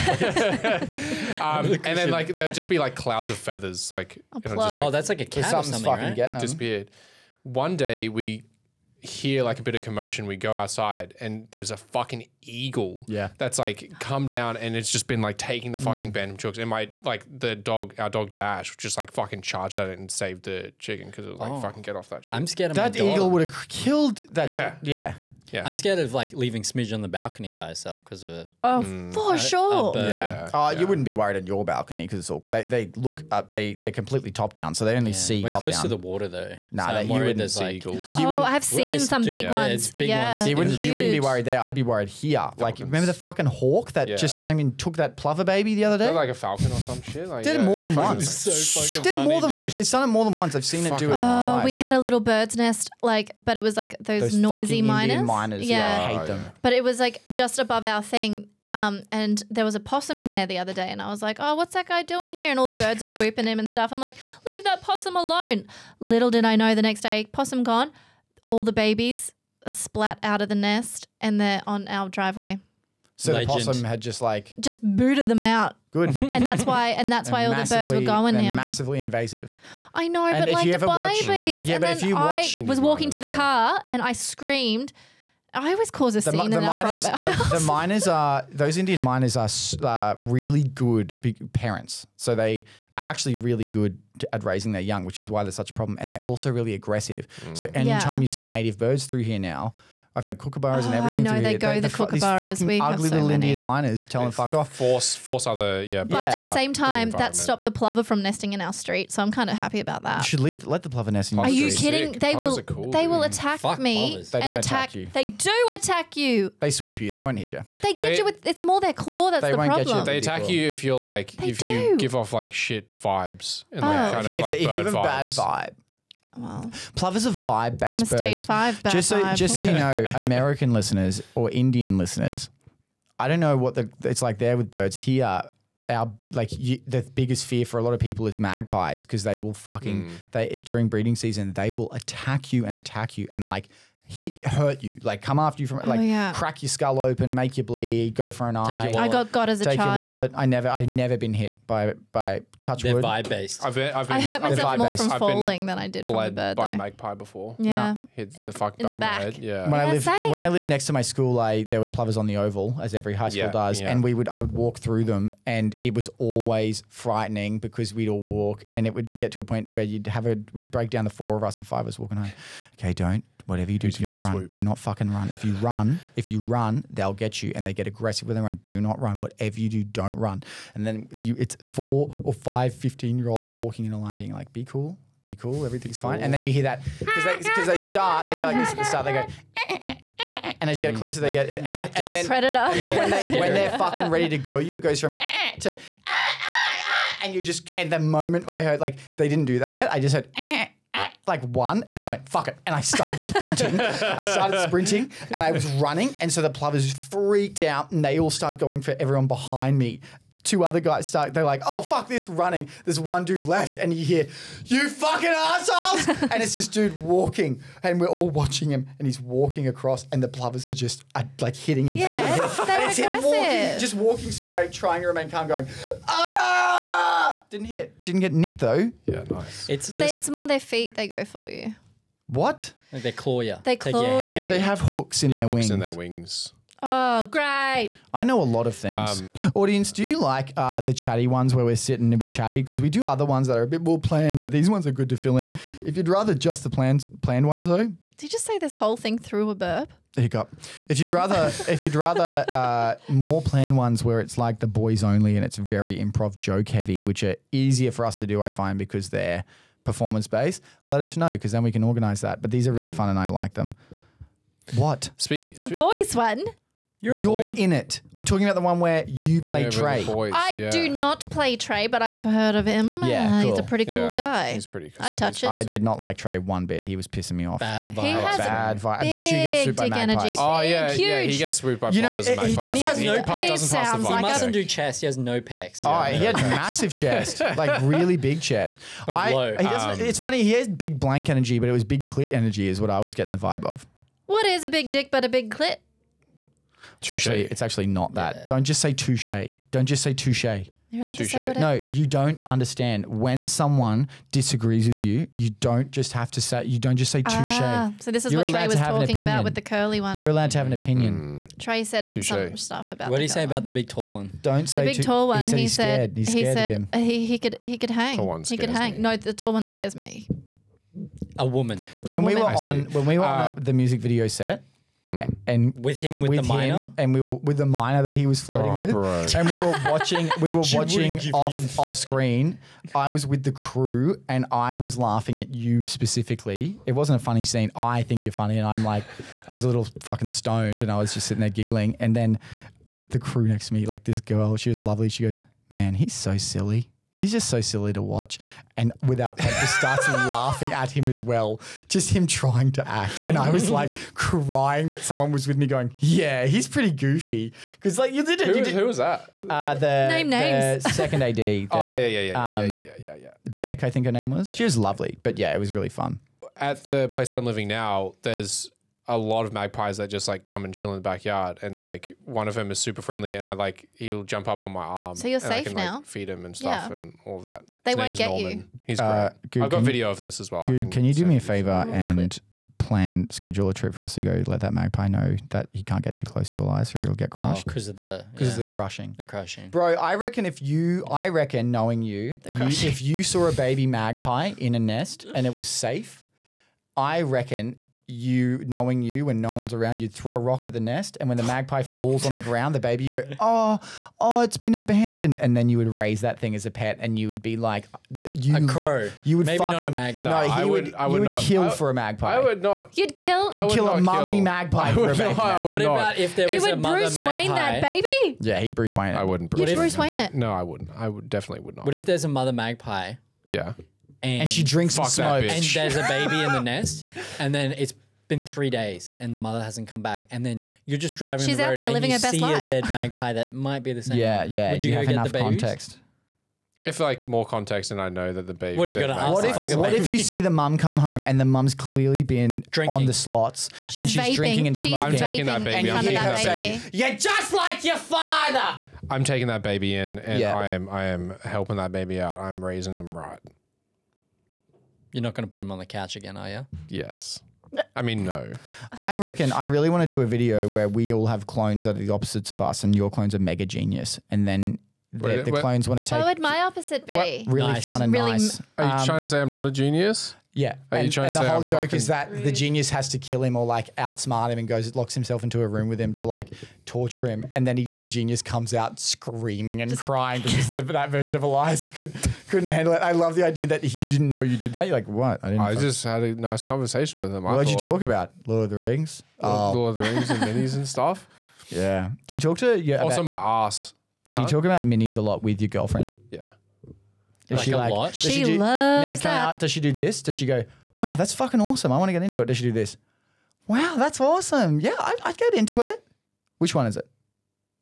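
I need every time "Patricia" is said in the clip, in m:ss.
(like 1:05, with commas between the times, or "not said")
not said.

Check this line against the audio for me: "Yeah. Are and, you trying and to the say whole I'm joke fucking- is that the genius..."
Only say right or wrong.
right.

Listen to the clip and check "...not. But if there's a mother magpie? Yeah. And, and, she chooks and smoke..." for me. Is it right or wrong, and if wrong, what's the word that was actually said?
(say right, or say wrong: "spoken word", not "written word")
wrong: "drinks", not "chooks".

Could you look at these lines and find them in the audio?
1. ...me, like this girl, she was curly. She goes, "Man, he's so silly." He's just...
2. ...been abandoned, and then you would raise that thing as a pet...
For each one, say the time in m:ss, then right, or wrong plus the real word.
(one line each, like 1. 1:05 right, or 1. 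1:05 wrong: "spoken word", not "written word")
1. 5:43 wrong: "lovely", not "curly"
2. 6:44 right.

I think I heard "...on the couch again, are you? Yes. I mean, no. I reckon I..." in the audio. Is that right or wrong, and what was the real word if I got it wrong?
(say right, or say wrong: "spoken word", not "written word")
right.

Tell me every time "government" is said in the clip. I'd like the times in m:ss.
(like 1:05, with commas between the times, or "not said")
not said.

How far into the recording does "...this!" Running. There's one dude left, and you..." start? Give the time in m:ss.
3:32.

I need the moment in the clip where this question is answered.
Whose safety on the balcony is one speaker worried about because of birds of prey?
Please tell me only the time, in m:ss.
0:26.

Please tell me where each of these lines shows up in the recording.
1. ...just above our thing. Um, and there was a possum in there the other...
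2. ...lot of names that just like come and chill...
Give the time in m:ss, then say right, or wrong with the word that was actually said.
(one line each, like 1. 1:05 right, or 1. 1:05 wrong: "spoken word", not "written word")
1. 0:57 right
2. 6:09 wrong: "magpies", not "names".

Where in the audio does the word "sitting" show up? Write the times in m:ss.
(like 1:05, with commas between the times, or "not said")
4:01, 5:41.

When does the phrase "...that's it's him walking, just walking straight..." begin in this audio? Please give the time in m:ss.
3:42.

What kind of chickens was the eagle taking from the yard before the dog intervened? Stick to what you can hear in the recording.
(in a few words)
Bantam chooks.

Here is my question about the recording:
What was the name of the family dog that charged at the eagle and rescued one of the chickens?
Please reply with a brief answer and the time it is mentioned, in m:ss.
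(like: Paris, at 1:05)
Dash, at 0:18.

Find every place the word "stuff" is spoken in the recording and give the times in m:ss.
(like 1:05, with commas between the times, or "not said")
1:03, 5:12, 6:16, 8:10.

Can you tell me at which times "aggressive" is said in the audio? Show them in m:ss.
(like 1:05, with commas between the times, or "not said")
1:36, 2:57.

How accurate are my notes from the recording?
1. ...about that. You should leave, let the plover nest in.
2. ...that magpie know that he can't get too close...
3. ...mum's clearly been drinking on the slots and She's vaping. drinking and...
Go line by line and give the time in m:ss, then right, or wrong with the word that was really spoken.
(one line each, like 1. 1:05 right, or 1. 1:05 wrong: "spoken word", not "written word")
1. 1:49 right
2. 6:24 right
3. 7:21 right.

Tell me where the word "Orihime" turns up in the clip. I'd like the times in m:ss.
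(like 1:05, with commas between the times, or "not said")
not said.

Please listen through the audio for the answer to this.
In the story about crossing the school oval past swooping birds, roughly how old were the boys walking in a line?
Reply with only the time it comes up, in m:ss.
3:02.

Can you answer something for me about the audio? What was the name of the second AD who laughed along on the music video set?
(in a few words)
Beck.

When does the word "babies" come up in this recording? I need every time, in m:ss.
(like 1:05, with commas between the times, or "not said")
1:08, 1:20.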